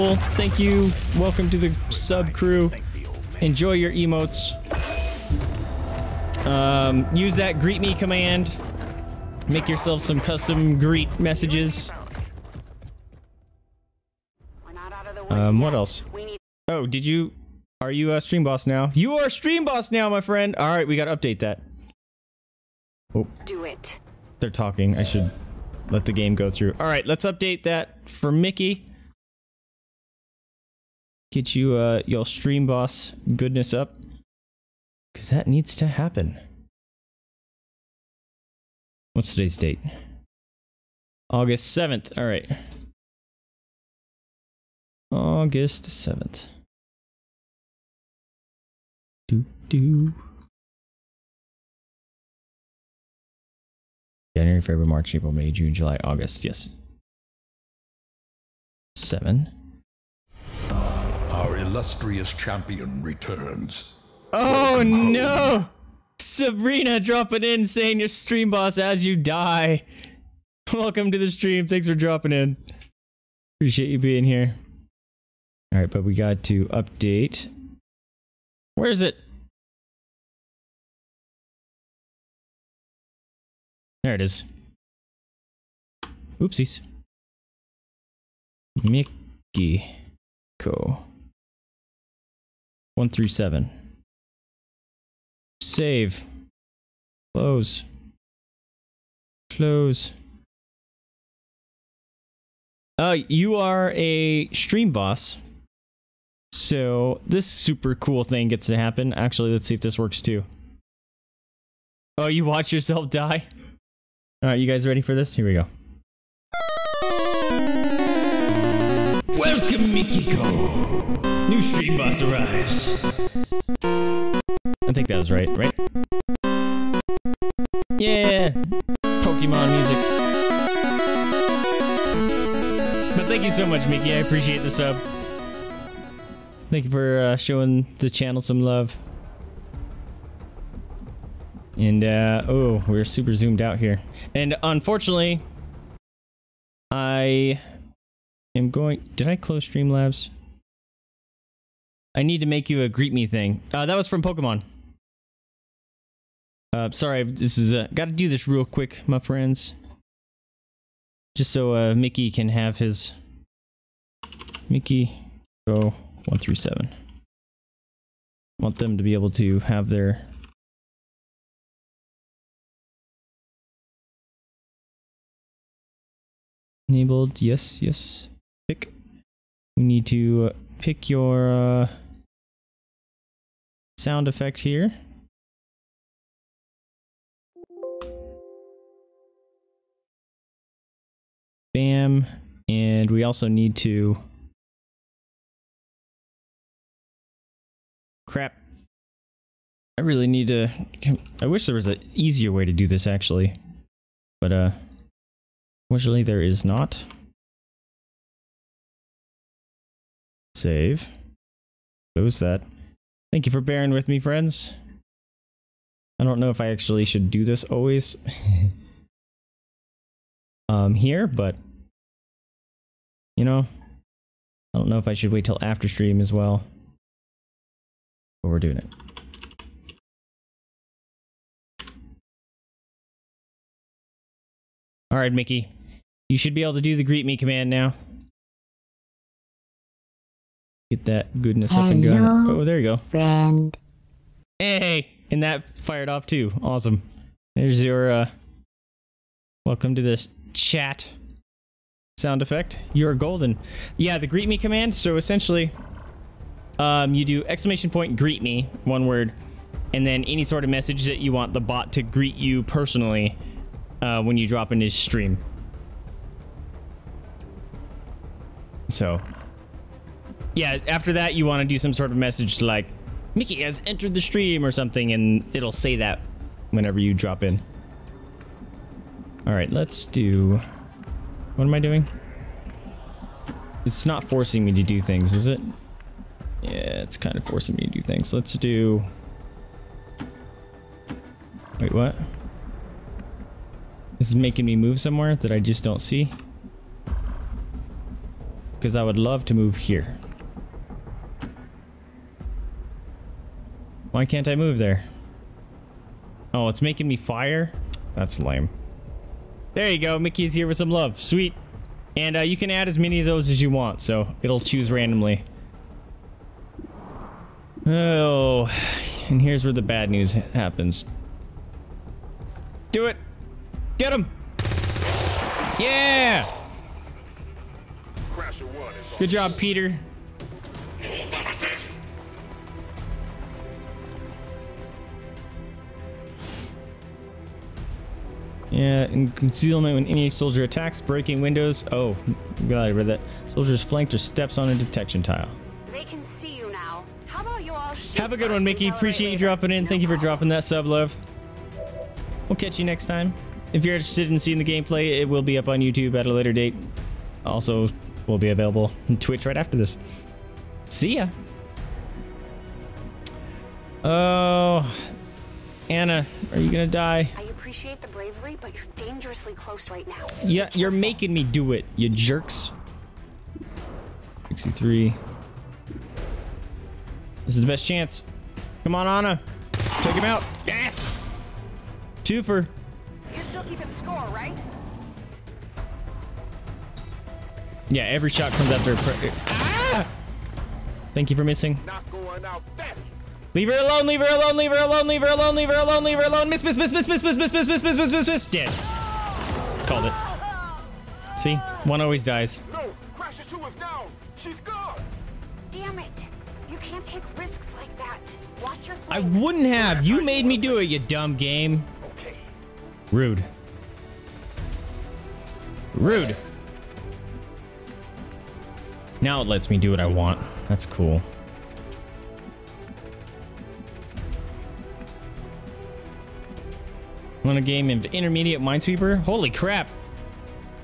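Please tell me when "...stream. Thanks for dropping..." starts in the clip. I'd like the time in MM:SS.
01:11.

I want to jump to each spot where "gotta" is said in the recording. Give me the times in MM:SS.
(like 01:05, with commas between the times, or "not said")
00:20, 02:37.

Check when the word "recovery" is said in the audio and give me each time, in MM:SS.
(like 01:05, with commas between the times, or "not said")
not said.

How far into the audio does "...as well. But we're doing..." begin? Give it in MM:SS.
03:46.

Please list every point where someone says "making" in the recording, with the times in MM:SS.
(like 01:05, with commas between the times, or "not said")
04:54, 05:06, 06:10.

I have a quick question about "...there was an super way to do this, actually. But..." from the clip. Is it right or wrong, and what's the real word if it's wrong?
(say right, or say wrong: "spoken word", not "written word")
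wrong: "easier", not "super".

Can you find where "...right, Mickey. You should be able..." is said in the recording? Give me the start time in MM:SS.
03:55.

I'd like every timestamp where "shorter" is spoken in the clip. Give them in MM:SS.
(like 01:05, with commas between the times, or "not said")
not said.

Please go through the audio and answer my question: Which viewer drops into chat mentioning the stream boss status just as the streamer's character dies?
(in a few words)
Sabrina.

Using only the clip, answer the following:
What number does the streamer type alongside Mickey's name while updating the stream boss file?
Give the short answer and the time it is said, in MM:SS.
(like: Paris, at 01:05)
137, at 01:32.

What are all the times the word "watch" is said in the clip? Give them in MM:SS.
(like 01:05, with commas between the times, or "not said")
01:52, 06:48.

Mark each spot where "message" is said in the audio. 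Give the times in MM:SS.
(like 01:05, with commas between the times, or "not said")
00:11, 04:20, 04:32.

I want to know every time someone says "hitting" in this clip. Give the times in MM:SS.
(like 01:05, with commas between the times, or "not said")
not said.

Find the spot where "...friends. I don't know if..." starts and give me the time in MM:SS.
03:34.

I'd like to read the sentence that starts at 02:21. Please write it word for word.
And, uh, oh, we're super zoomed out here.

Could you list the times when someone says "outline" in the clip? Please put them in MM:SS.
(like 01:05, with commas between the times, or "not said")
not said.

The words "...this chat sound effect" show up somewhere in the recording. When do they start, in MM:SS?
04:10.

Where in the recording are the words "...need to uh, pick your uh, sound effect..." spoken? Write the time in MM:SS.
02:59.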